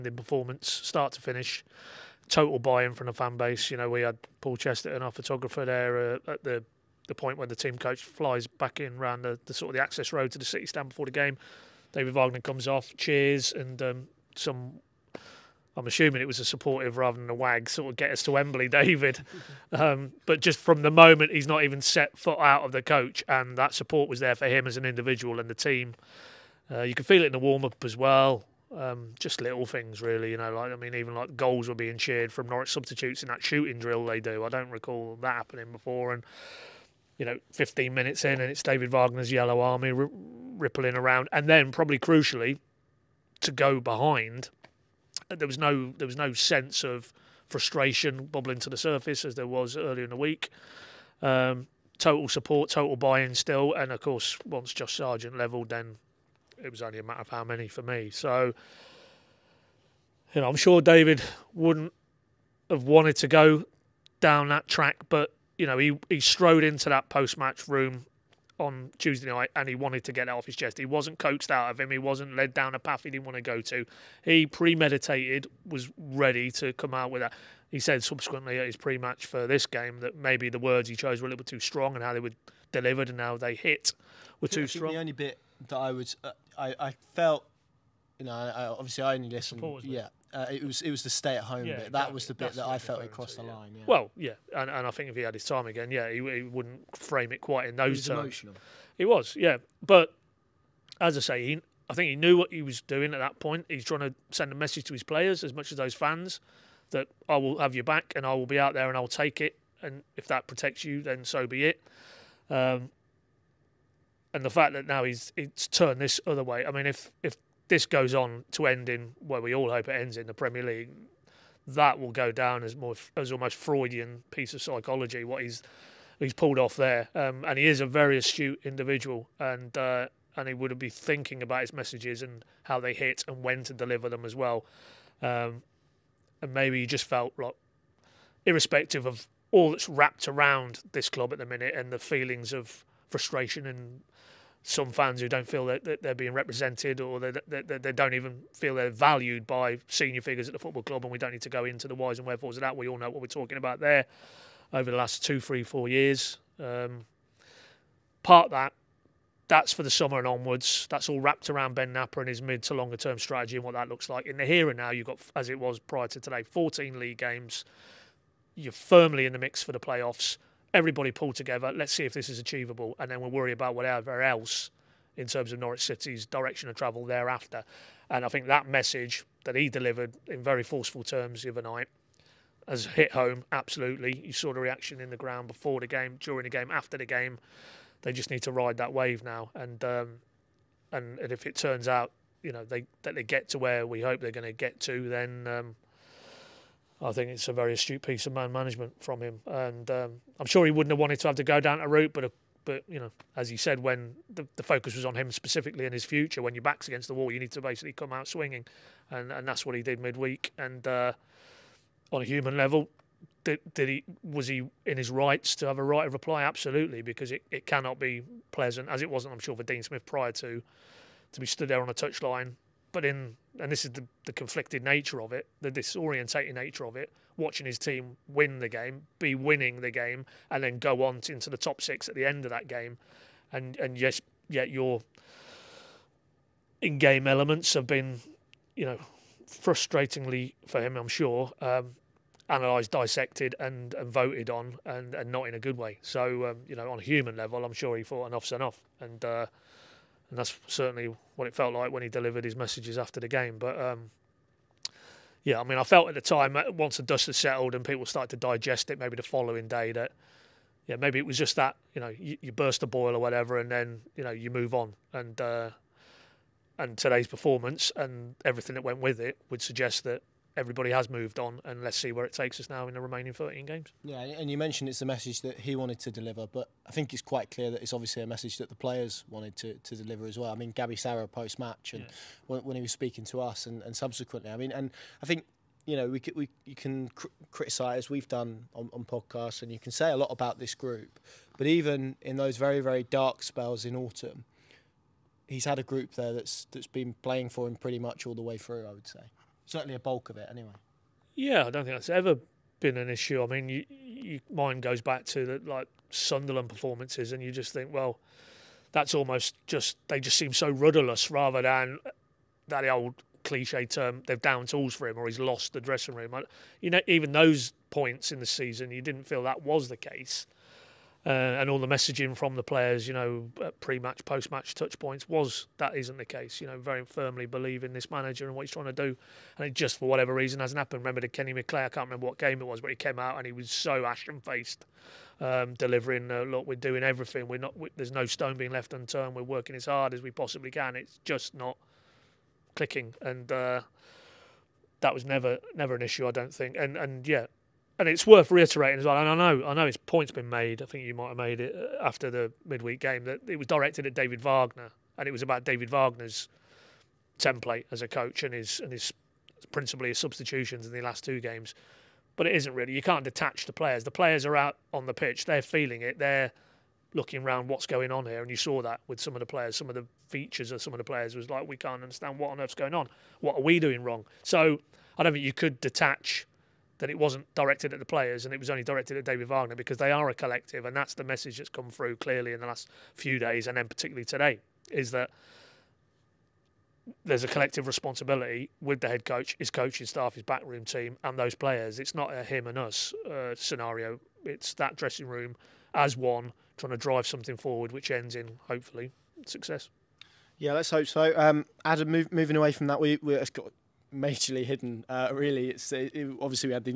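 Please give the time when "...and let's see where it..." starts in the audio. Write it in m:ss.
4:31.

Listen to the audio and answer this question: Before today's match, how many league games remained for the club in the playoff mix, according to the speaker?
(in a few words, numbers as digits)
14.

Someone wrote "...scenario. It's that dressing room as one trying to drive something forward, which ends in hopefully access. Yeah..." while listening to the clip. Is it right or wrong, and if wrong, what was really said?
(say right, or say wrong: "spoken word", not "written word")
wrong: "success", not "access".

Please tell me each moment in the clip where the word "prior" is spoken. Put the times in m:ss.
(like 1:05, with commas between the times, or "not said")
2:45, 3:40.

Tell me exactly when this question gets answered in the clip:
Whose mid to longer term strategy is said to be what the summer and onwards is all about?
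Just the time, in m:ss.
2:41.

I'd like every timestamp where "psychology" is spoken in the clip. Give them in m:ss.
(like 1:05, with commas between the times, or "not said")
2:04.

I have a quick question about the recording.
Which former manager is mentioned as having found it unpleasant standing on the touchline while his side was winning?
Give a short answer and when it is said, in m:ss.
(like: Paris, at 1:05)
Dean Smith, at 3:39.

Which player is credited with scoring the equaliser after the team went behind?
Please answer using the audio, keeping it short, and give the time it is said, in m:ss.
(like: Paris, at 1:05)
Josh Sargent, at 0:54.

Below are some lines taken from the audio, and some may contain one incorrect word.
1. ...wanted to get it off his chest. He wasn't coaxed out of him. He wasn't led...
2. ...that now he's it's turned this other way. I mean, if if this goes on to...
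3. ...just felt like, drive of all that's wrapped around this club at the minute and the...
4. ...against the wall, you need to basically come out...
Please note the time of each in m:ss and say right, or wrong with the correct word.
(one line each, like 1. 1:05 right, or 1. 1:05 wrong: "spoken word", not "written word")
1. 1:09 right
2. 1:54 right
3. 2:16 wrong: "irrespective", not "drive"
4. 3:26 right.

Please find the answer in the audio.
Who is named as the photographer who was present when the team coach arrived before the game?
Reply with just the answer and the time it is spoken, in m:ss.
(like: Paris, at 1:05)
Paul Chesterton, at 0:04.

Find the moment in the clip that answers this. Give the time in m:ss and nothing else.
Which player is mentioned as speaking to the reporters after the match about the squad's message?
4:40.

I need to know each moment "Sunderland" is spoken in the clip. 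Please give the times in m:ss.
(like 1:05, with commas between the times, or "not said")
5:06.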